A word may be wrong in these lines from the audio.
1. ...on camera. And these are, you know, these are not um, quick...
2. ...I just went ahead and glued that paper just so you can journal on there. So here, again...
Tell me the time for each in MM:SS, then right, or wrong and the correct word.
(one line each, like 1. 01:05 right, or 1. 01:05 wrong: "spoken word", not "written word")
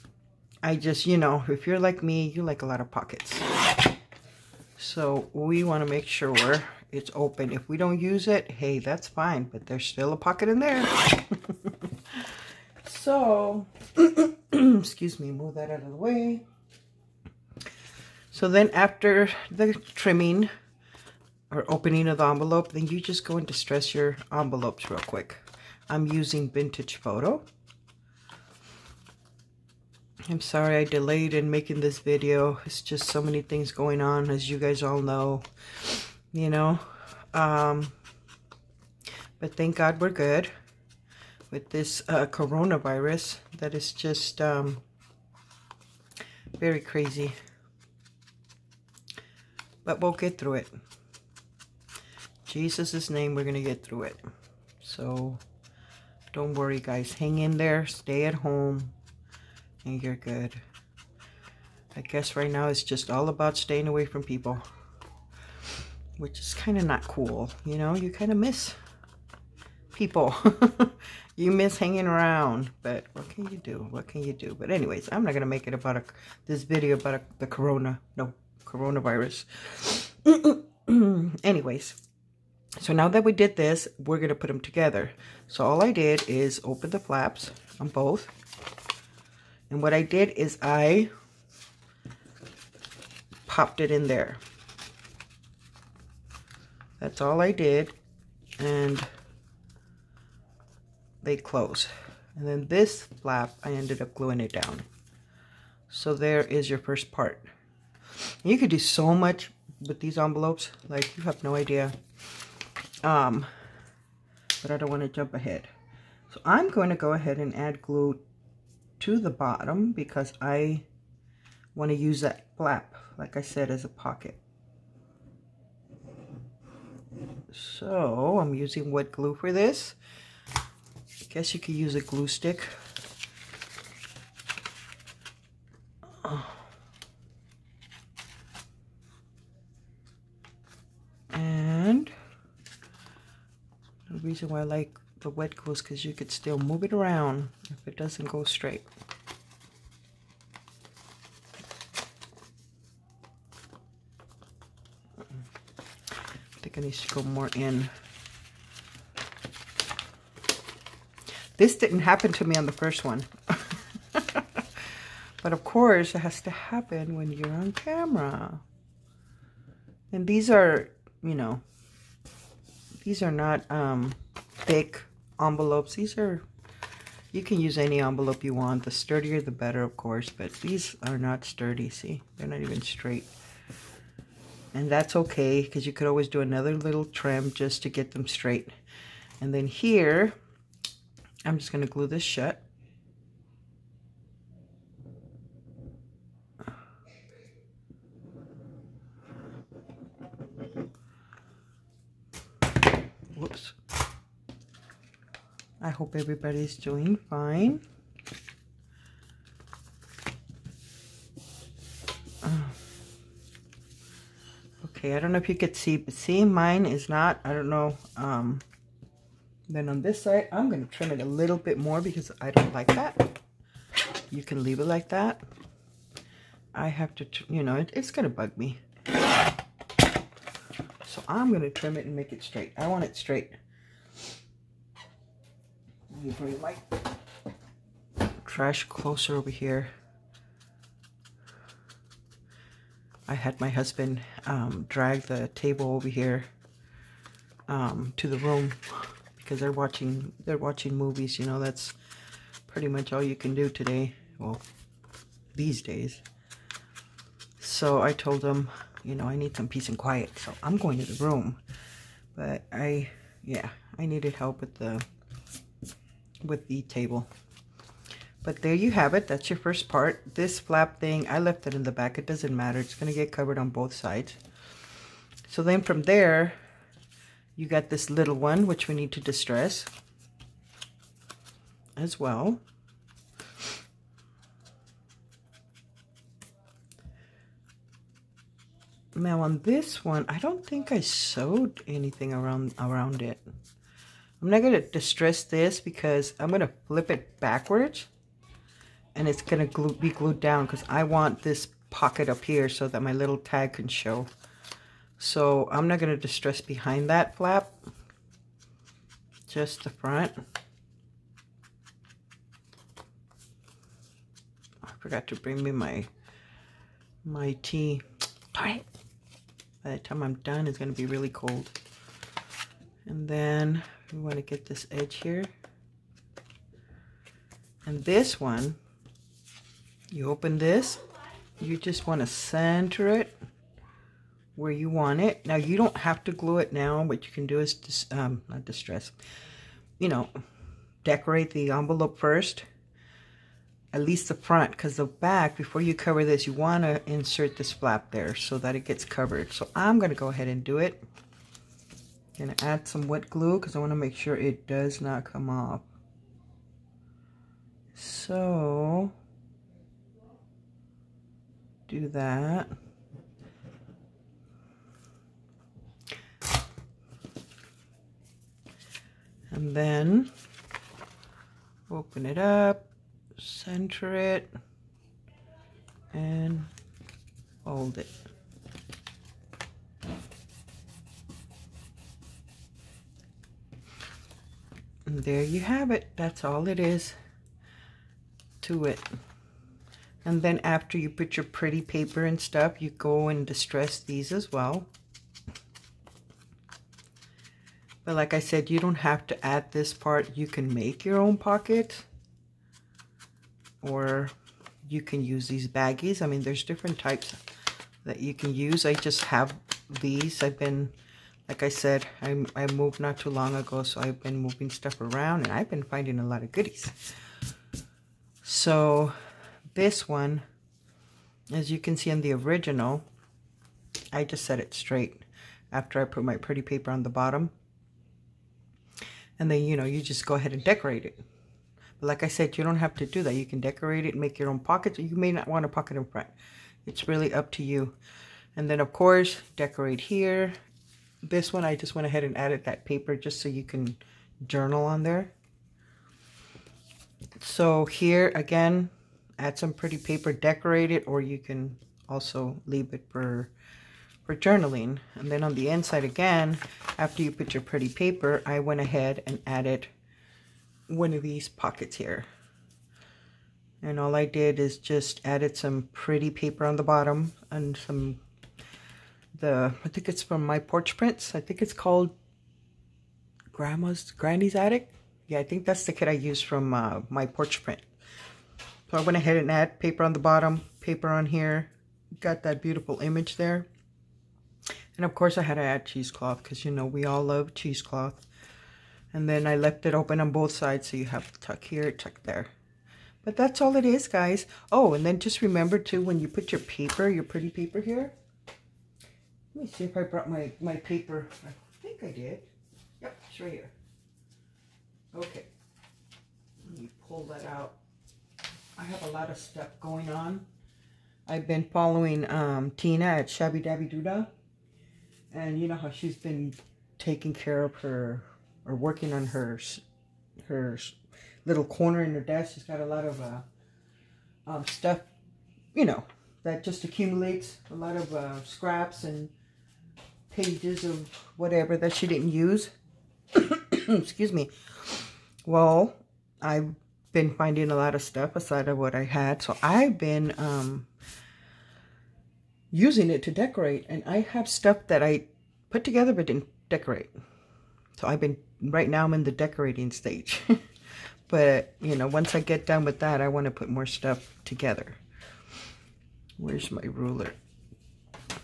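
1. 02:47 wrong: "thick", not "quick"
2. 07:21 wrong: "added", not "glued".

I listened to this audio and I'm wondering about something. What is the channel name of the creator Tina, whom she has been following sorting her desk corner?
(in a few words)
Shabby Dabby Doodah.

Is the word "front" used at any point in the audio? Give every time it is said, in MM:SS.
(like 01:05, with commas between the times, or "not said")
05:09, 05:44, 07:16.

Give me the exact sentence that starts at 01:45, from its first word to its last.
So there is your first part.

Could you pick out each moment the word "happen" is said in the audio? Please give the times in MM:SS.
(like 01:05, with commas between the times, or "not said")
02:42, 02:46.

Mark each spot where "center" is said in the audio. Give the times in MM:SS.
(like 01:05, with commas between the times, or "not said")
05:32, 06:13.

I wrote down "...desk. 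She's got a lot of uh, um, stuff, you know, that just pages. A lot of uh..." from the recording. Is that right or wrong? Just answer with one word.
wrong.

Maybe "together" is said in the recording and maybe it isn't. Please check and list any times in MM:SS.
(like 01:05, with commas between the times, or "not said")
01:24, 09:05, 09:14.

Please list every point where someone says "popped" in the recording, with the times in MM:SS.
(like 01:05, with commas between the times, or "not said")
01:33.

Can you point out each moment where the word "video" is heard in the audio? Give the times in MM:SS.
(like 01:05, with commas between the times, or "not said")
00:31, 01:16.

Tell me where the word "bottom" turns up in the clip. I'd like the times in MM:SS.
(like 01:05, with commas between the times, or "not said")
01:59, 07:07, 07:46, 08:00.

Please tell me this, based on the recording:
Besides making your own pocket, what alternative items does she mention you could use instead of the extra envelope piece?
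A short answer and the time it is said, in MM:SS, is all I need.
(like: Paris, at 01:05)
Baggies, at 06:45.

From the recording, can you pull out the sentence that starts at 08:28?
I have a lot of stuff going on.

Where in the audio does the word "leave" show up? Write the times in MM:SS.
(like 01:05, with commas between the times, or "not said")
03:44, 07:32.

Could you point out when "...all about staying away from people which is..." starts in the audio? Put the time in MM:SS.
01:03.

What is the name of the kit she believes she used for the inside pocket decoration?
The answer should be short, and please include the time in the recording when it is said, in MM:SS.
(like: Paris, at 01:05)
Granny's Attic, at 07:54.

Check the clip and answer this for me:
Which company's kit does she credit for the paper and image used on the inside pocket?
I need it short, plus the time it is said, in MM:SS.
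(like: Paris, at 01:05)
My Porch Prints, at 07:50.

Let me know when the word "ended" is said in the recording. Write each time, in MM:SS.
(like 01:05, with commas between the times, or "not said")
01:43.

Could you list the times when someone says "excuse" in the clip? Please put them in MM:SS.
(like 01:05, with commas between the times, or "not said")
00:14, 08:53.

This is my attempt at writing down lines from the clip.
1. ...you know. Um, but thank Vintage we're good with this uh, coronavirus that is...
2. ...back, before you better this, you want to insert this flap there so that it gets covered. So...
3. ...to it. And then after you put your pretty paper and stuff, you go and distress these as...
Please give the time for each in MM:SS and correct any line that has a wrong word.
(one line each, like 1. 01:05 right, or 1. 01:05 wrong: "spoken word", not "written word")
1. 00:36 wrong: "God", not "Vintage"
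2. 05:45 wrong: "cover", not "better"
3. 06:28 right.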